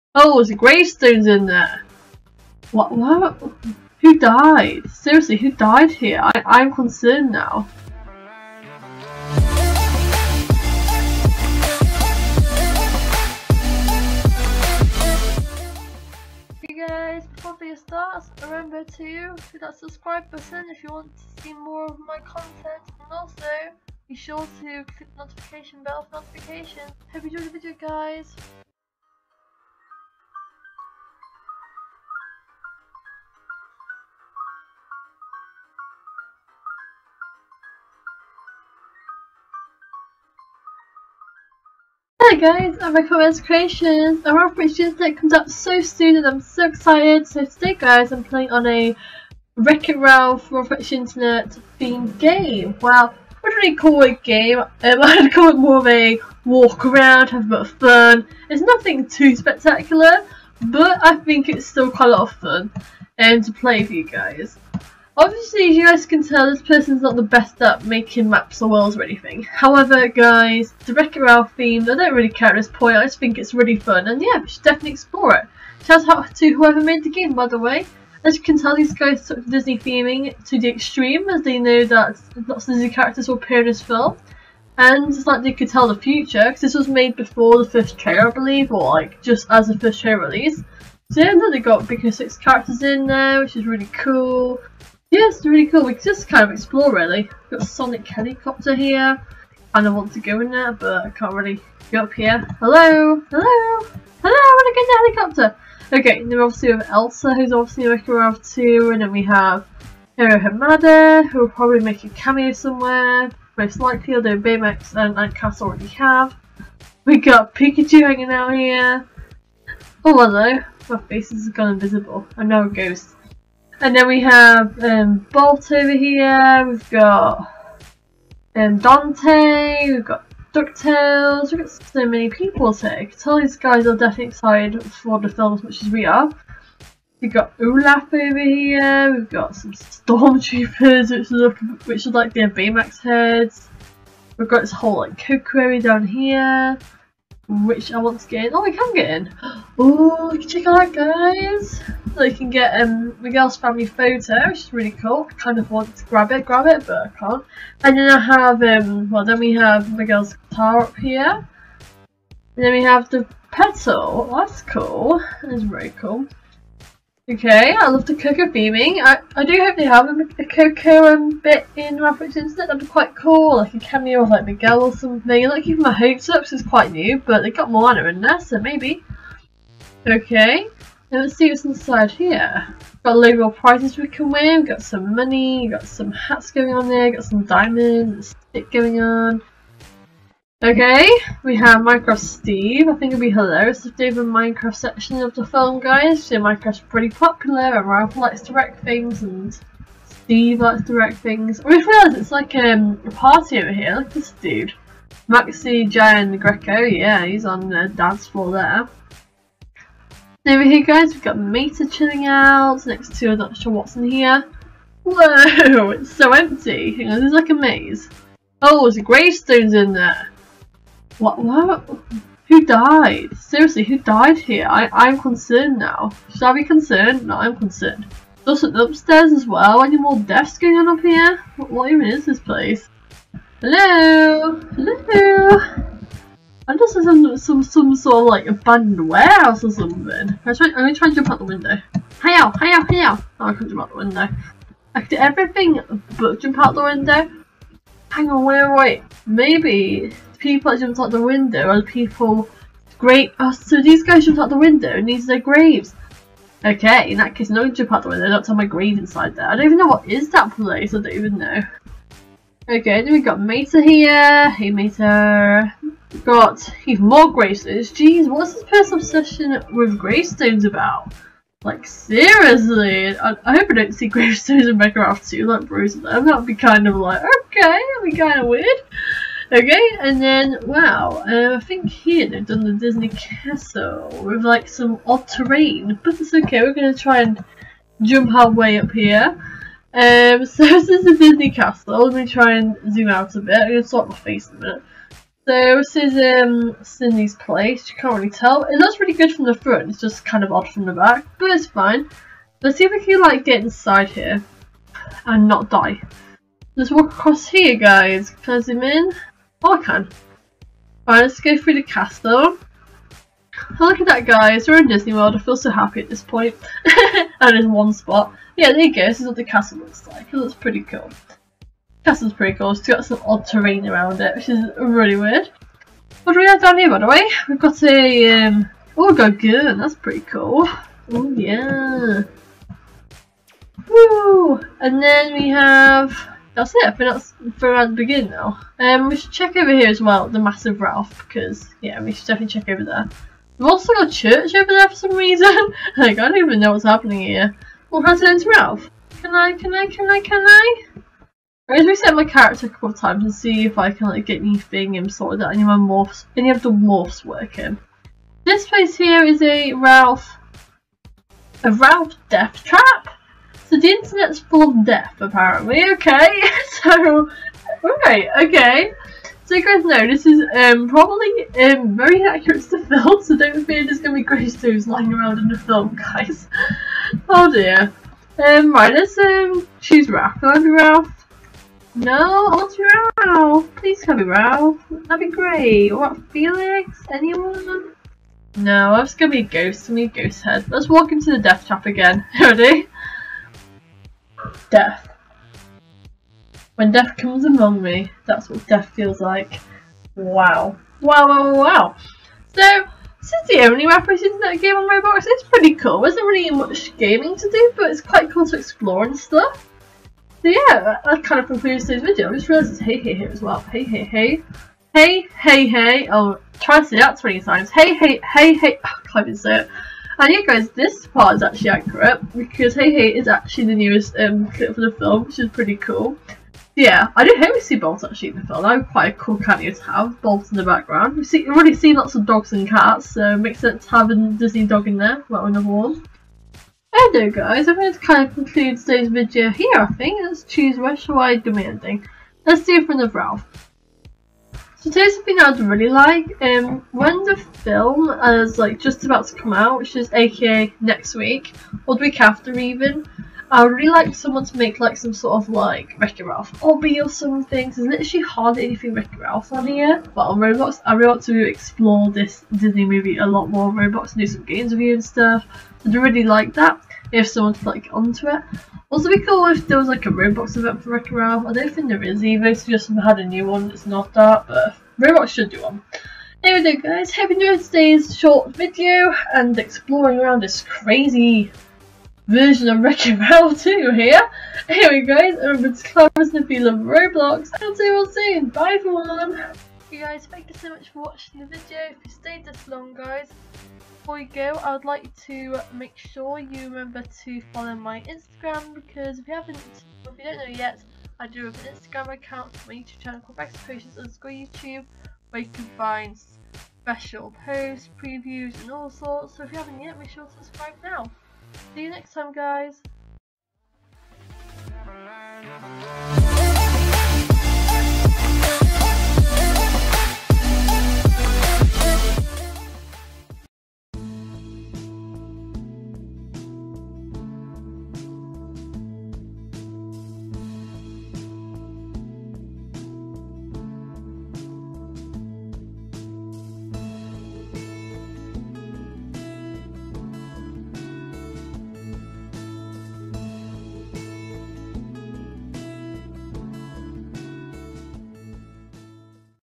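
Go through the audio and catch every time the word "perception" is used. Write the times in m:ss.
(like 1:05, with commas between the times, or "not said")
not said.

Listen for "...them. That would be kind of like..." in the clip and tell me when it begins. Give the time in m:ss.
4:35.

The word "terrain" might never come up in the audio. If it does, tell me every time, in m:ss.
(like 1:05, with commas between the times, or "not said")
4:45, 5:23.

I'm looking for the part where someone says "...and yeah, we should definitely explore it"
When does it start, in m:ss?
1:14.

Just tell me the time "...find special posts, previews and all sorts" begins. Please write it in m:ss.
8:25.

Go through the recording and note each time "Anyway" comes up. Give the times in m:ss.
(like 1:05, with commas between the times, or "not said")
7:00, 7:16, 7:56, 8:04.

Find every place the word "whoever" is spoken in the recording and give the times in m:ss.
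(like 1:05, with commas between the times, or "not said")
1:16.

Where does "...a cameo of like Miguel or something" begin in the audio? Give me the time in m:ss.
2:53.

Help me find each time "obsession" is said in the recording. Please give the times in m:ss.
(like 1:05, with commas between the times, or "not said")
4:29.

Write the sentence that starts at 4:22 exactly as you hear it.
Okay, then we got Mater here.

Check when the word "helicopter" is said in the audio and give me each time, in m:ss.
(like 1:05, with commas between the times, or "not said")
1:38, 1:45.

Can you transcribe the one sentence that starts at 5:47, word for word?
Well, oh, how to enter Ralph?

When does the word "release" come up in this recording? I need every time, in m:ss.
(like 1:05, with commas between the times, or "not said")
1:30.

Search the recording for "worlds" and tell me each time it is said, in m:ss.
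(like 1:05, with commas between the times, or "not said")
1:08, 5:15.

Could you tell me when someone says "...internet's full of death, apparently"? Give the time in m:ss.
6:03.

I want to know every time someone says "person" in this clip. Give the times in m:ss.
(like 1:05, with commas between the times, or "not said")
1:06, 4:28.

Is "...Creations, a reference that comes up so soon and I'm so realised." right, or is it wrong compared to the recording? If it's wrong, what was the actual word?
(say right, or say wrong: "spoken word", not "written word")
wrong: "excited", not "realised".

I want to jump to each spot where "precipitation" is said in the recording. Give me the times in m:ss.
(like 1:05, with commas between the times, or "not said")
not said.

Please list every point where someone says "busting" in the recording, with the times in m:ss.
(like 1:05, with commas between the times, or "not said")
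not said.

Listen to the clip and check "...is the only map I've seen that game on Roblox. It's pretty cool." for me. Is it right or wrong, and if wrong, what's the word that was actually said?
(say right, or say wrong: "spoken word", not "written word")
right.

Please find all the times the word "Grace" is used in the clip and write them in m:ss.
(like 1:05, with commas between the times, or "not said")
6:14.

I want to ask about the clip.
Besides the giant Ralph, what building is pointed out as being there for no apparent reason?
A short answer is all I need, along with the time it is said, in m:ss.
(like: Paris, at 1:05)
a church, at 5:44.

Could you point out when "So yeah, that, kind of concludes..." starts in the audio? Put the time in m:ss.
6:50.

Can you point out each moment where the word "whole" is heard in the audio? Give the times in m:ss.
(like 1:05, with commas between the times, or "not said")
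2:24.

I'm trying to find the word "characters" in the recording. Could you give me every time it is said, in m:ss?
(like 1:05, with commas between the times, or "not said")
1:22, 1:32, 5:52.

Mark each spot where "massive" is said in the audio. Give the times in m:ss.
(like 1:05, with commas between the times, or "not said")
5:40.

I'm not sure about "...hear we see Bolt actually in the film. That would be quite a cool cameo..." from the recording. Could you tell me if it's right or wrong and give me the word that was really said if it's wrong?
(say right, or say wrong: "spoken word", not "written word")
right.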